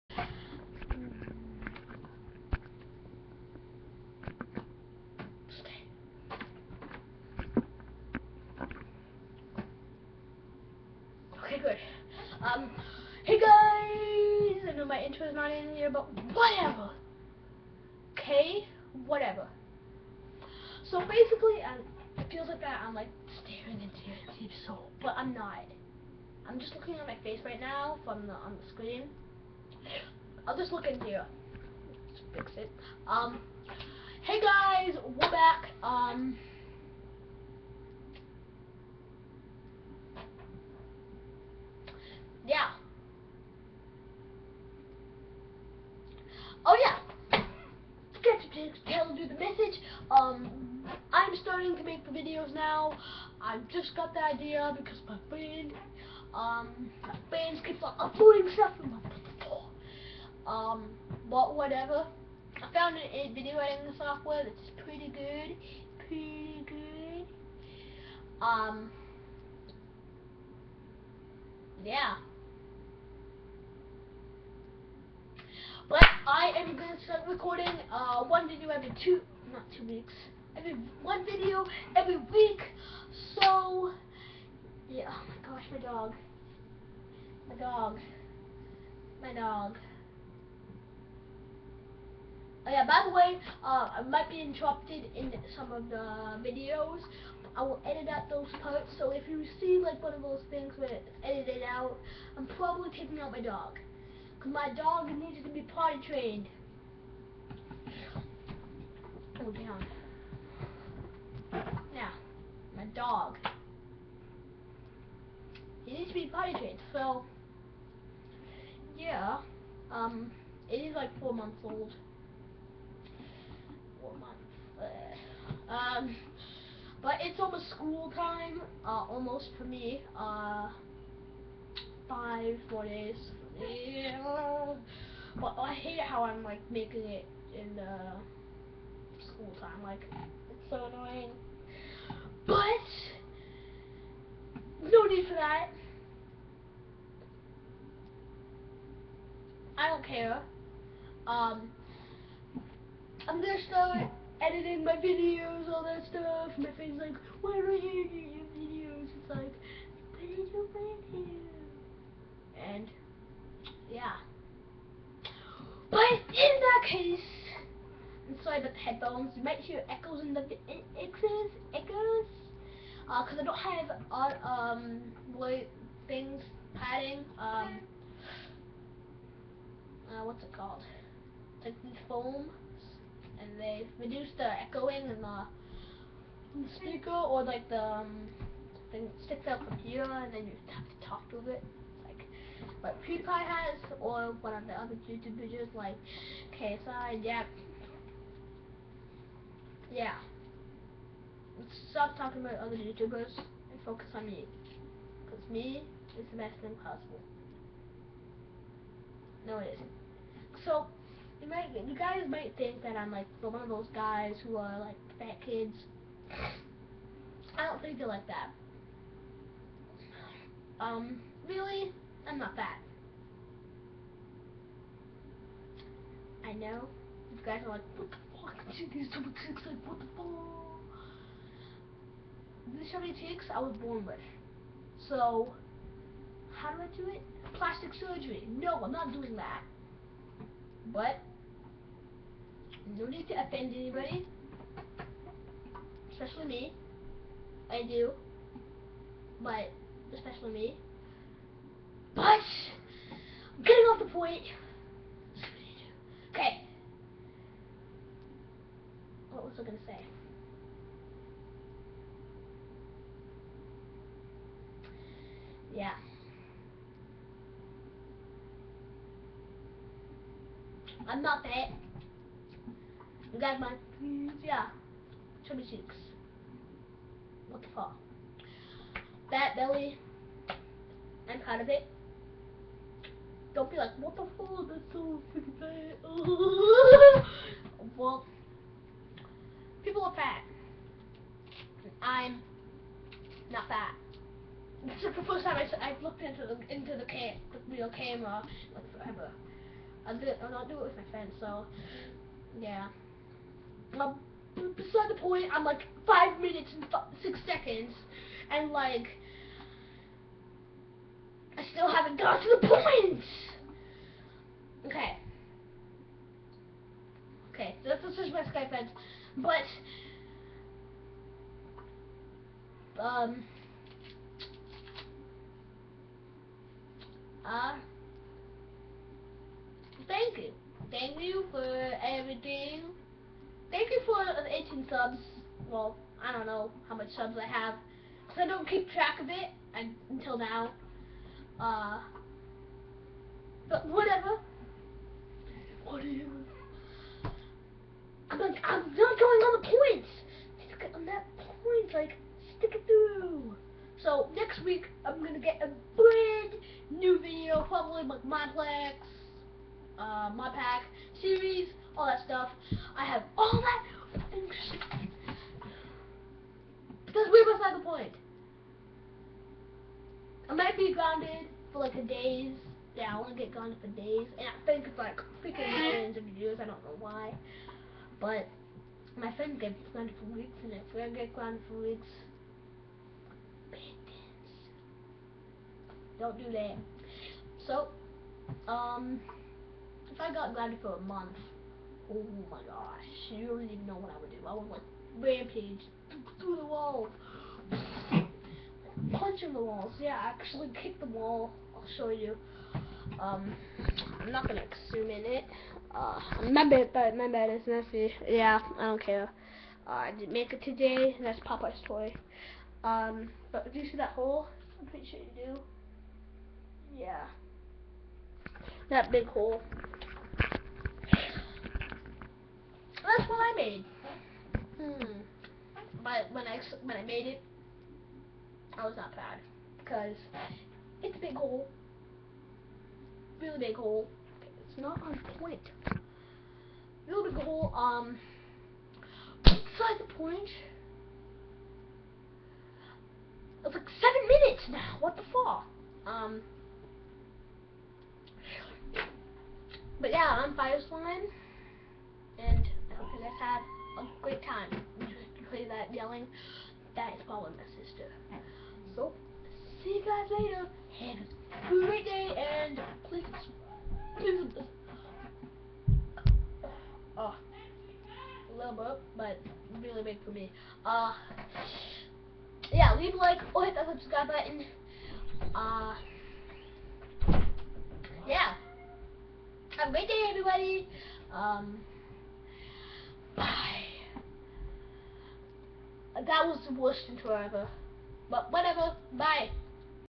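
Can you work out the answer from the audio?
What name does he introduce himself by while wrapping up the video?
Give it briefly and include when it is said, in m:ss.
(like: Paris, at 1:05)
Fireslime, at 7:30.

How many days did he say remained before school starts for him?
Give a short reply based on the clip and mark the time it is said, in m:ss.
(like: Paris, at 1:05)
5 days, at 2:12.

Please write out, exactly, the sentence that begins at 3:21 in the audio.
Stop talking about other YouTubers and focus on me.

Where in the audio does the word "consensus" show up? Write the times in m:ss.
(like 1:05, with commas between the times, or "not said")
not said.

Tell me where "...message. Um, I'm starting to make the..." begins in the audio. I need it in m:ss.
0:49.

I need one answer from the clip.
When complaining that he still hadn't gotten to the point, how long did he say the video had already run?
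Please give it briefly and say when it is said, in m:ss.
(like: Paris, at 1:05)
5 minutes and 6 seconds, at 5:06.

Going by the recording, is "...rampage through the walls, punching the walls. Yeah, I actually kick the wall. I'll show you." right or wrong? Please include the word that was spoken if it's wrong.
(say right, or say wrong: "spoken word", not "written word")
right.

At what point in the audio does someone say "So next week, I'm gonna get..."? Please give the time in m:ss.
5:54.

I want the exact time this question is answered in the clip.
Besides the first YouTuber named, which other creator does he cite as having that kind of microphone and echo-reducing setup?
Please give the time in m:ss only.
3:16.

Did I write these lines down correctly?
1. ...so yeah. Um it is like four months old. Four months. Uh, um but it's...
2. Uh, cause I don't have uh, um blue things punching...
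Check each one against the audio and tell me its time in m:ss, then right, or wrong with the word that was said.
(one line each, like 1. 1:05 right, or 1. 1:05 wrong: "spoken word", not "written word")
1. 1:56 right
2. 2:53 wrong: "padding", not "punching".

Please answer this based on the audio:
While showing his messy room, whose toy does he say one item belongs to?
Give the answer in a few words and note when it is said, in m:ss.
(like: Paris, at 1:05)
Popeye's, at 6:51.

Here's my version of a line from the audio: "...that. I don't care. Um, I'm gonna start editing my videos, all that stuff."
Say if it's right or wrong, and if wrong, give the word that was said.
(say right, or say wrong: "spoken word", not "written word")
right.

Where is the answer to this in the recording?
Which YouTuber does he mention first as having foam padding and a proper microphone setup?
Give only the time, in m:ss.
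3:13.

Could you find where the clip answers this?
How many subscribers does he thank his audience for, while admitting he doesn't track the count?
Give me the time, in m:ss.
5:34.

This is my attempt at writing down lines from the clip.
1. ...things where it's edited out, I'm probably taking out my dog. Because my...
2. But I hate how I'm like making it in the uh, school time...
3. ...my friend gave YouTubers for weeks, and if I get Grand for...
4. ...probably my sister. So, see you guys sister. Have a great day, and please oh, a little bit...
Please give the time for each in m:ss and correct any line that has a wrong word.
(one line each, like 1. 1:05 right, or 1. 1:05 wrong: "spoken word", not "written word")
1. 1:40 right
2. 2:15 right
3. 6:19 wrong: "Grand", not "YouTubers"
4. 7:37 wrong: "later", not "sister".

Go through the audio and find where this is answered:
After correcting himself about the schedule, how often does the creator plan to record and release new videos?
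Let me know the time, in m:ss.
1:21.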